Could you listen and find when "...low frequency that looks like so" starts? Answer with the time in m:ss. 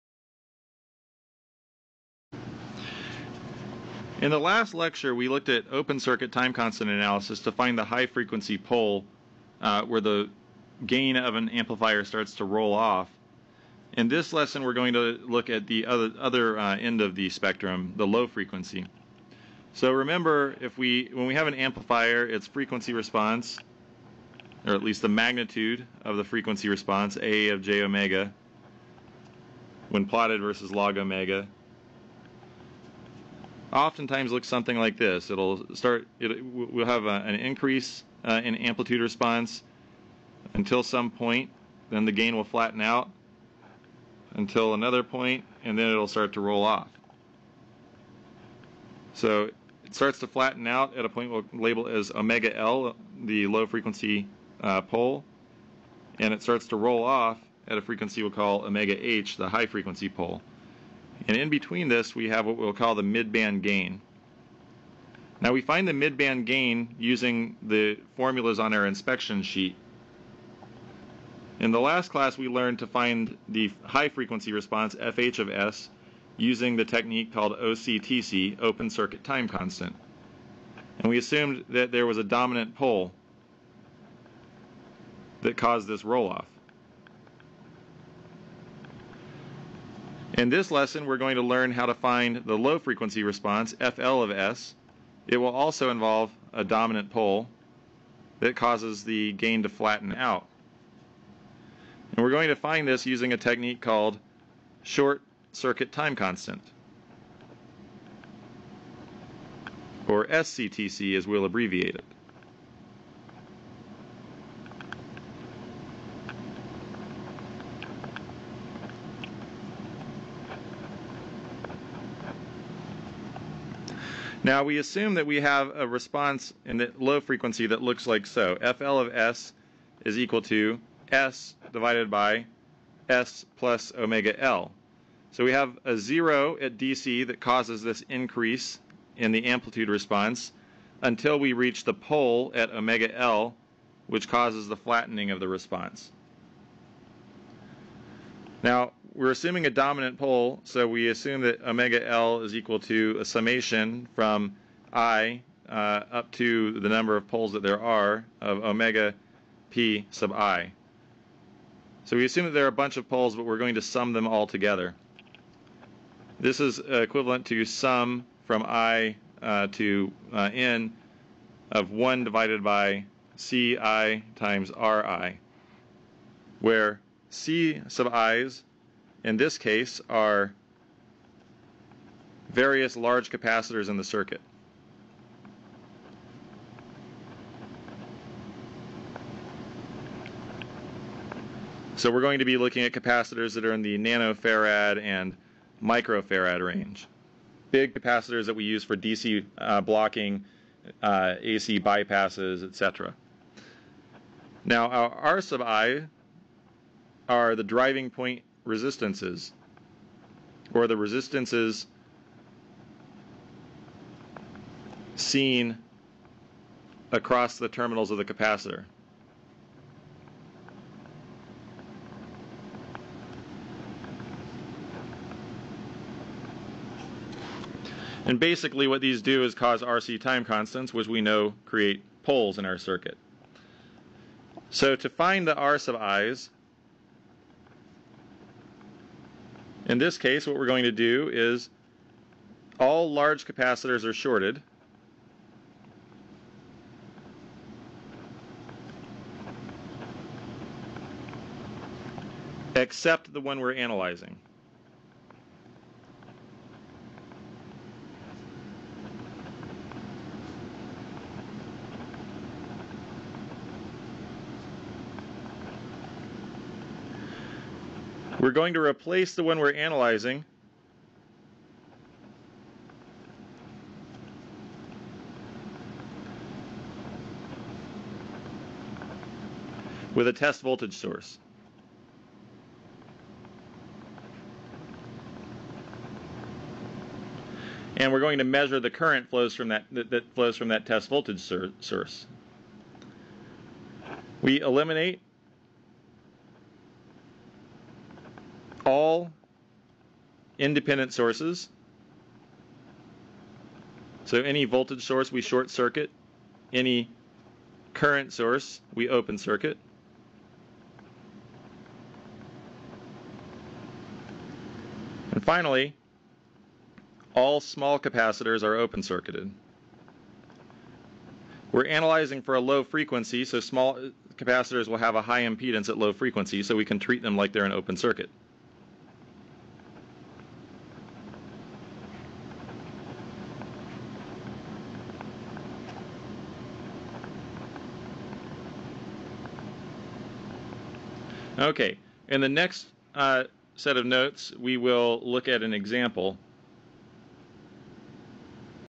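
2:06.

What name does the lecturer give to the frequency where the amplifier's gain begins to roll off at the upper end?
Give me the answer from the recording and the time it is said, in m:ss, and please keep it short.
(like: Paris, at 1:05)
omega H, at 0:58.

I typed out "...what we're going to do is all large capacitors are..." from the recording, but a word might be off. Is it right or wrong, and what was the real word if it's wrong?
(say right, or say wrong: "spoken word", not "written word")
right.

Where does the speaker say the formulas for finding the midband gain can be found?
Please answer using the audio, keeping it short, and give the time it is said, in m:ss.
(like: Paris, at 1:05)
inspection sheet, at 1:08.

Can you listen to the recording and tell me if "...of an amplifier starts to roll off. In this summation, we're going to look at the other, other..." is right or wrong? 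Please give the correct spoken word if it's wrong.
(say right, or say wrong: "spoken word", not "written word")
wrong: "lesson", not "summation".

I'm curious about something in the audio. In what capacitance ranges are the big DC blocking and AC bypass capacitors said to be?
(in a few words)
nanofarad and microfarad.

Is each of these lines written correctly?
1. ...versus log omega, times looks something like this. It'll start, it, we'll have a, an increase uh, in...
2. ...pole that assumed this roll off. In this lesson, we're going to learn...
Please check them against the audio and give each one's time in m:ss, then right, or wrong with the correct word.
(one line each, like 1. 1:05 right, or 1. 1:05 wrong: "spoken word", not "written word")
1. 0:30 wrong: "oftentimes", not "times"
2. 1:22 wrong: "caused", not "assumed".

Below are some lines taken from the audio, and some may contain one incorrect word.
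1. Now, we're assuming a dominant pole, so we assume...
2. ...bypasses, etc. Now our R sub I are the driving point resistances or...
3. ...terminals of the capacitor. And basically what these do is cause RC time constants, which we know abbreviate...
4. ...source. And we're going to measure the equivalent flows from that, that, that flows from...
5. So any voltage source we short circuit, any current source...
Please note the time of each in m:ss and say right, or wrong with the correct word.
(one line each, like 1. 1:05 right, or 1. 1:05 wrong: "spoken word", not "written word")
1. 2:28 right
2. 3:21 right
3. 3:37 wrong: "create", not "abbreviate"
4. 4:40 wrong: "current", not "equivalent"
5. 5:04 right.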